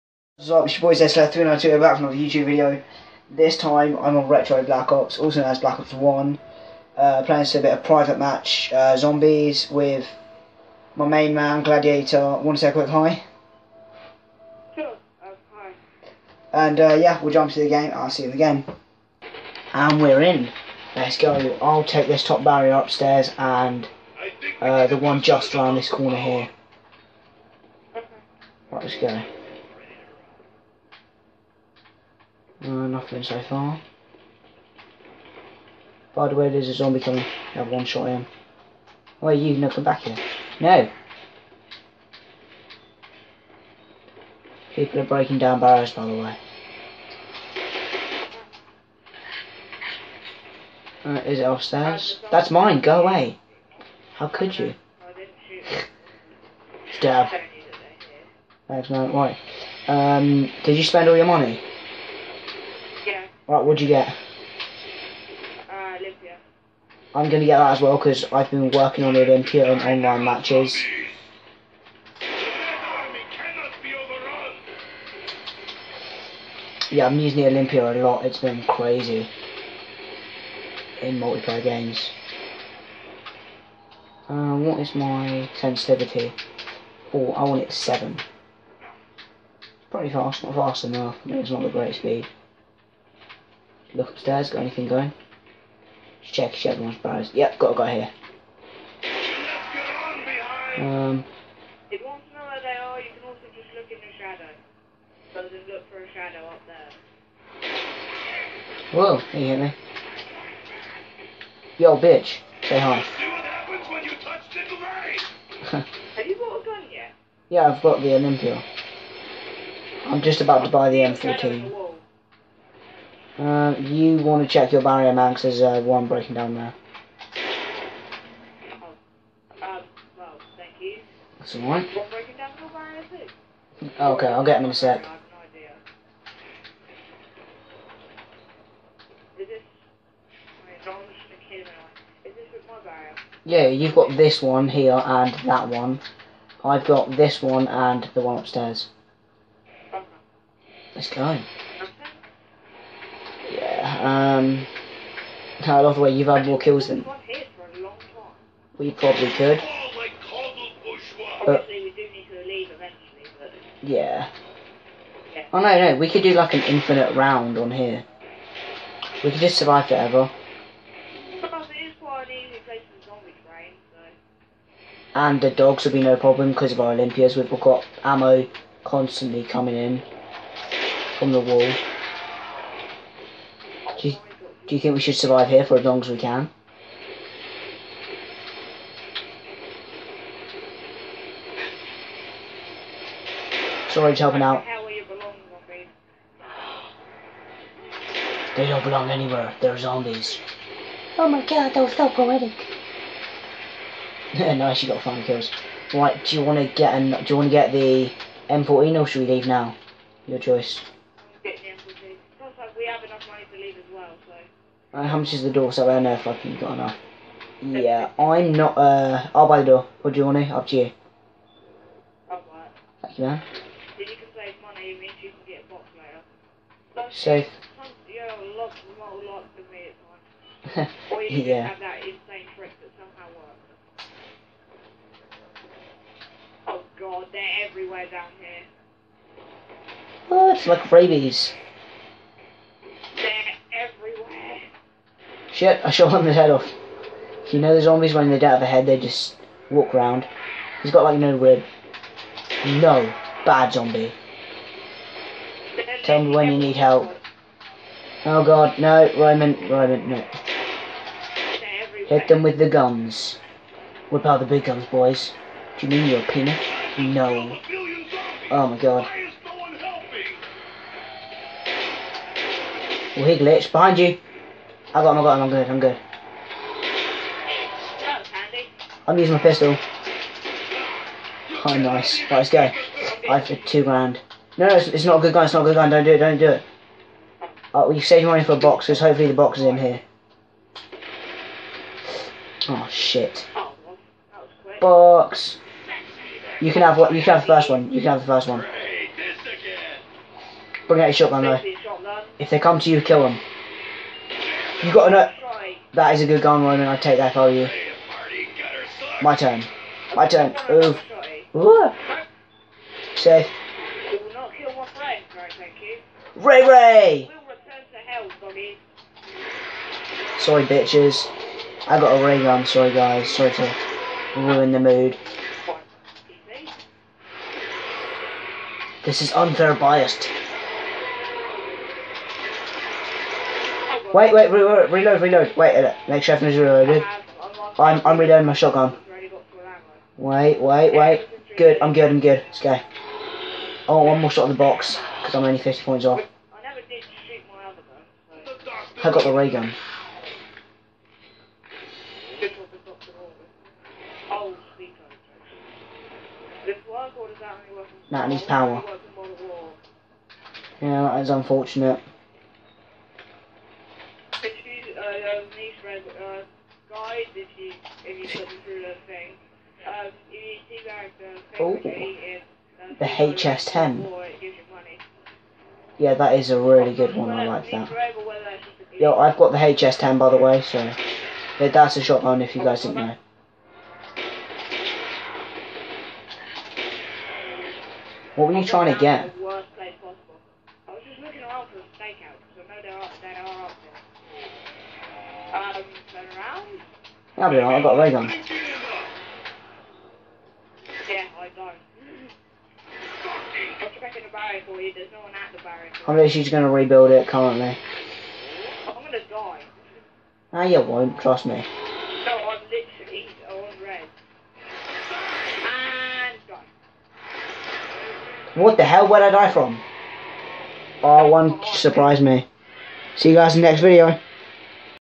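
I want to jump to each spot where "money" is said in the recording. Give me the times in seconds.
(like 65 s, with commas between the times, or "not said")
61 s, 213 s, 224 s, 288 s.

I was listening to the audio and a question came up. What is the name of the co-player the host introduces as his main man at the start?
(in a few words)
Gladiator.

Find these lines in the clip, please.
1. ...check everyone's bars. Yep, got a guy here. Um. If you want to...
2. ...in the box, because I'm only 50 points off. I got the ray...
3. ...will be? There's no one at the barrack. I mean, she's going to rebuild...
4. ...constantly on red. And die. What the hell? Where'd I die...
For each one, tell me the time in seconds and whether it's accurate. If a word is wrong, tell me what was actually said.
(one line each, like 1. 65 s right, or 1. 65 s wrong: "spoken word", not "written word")
1. 96 s right
2. 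344 s right
3. 404 s right
4. 412 s wrong: "literally", not "constantly".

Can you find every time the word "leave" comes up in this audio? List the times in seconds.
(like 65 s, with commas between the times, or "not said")
209 s, 213 s.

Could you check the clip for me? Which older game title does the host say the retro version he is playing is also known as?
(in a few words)
Black Ops 1.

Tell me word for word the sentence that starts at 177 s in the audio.
We've got ammo constantly coming in from the wall.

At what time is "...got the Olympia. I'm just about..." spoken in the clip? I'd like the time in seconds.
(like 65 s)
117 s.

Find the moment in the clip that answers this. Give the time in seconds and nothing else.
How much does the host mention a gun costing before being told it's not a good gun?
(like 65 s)
283 s.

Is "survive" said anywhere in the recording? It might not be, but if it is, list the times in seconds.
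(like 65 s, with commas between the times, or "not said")
169 s, 185 s.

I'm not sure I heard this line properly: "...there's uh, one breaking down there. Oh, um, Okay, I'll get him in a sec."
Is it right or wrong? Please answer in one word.
right.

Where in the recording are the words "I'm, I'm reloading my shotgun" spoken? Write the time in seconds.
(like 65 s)
337 s.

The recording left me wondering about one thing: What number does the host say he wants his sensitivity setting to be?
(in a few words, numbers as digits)
7.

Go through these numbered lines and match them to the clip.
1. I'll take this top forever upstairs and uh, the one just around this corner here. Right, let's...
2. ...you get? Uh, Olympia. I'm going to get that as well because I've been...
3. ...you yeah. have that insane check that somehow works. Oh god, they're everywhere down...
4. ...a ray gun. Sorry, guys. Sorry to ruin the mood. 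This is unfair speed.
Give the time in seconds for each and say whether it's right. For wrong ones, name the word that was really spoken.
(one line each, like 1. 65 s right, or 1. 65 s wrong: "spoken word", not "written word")
1. 21 s wrong: "barrier", not "forever"
2. 63 s right
3. 231 s wrong: "trick", not "check"
4. 322 s wrong: "biased", not "speed".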